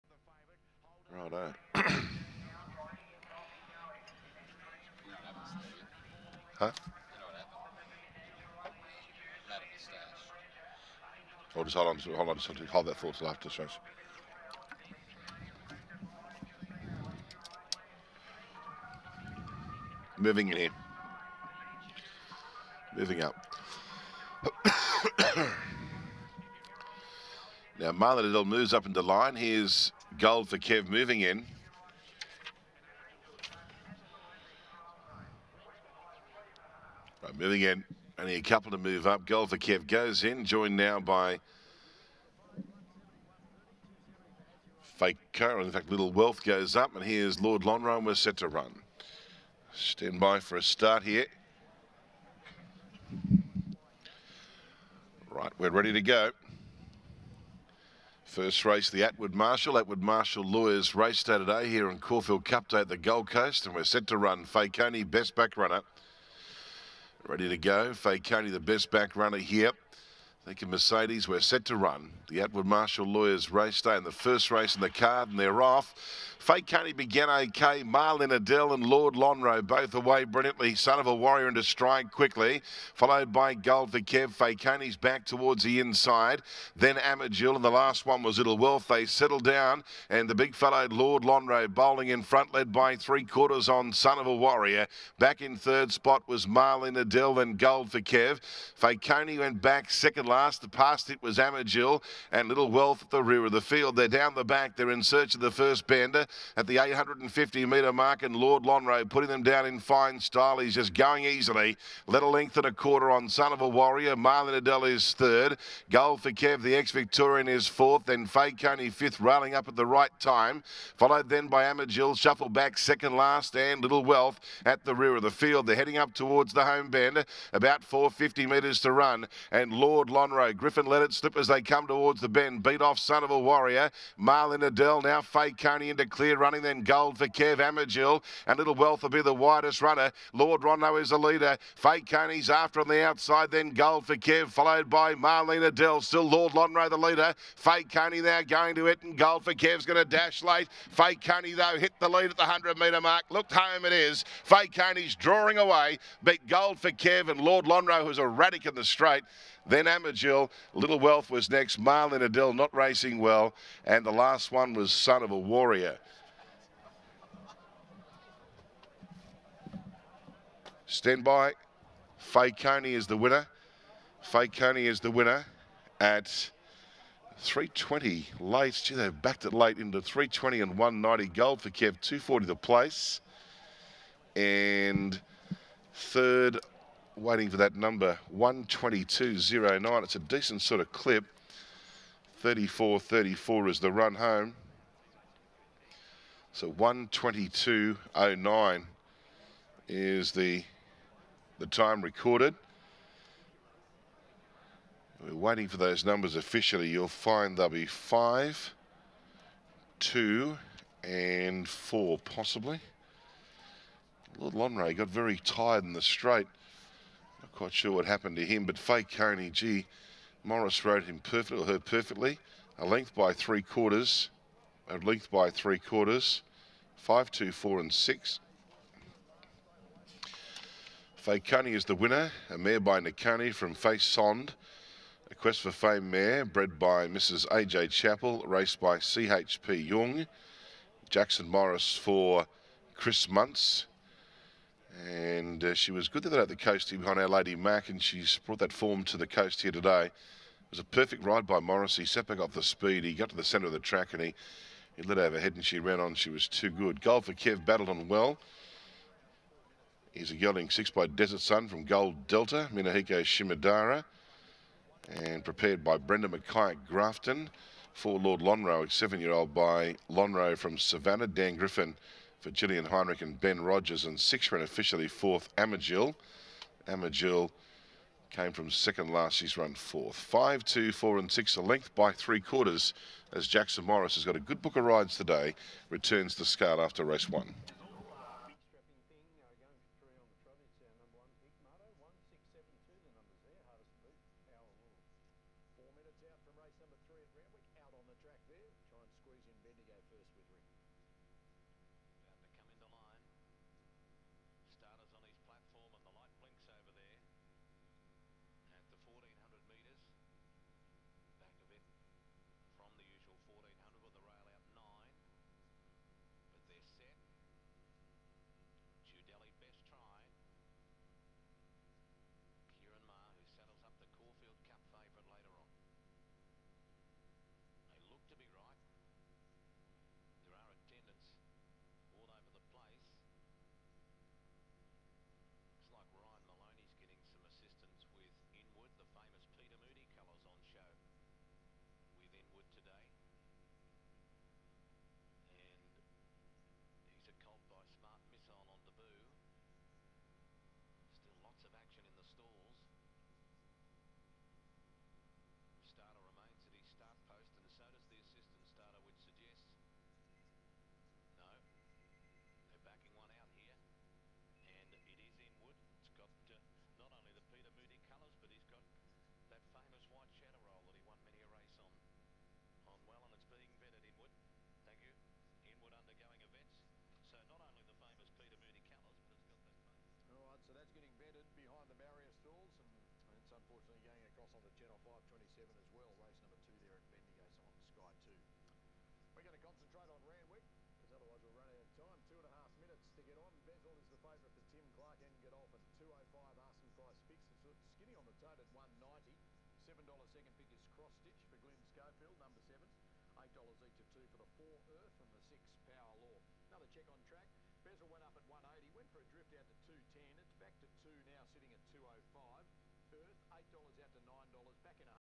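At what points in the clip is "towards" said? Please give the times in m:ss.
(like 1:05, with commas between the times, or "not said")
1:25, 2:06, 2:11.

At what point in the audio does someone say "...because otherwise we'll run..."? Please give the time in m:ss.
6:30.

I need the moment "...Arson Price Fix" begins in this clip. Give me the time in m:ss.
6:36.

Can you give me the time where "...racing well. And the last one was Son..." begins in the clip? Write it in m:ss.
2:42.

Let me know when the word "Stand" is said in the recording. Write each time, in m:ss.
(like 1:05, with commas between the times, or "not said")
0:49, 2:50.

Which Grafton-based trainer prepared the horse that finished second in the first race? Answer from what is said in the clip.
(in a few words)
Brenda McKay.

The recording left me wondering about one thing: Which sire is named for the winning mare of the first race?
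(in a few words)
Nakani.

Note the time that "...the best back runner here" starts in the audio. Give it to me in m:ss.
1:08.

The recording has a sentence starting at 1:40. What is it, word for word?
The past it was Amagil and Little Wealth at the rear of the field.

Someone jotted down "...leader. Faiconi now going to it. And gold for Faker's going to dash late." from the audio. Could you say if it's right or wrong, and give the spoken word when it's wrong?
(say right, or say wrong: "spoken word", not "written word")
wrong: "Kev", not "Faker".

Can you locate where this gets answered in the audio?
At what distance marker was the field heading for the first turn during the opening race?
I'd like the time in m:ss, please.
1:46.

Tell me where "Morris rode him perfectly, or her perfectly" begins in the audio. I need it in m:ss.
3:40.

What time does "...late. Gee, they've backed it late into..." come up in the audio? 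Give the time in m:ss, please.
2:58.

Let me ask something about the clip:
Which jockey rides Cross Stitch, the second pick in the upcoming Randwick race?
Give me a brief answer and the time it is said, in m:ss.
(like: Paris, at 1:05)
Glyn Schofield, at 6:41.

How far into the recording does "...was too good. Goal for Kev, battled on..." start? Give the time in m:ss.
4:16.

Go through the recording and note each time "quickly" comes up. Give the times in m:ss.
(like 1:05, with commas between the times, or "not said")
1:22.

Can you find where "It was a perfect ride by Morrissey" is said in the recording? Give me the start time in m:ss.
4:10.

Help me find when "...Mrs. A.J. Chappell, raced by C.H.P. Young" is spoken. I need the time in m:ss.
3:57.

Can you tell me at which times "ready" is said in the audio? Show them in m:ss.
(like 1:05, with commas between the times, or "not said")
0:55, 1:07.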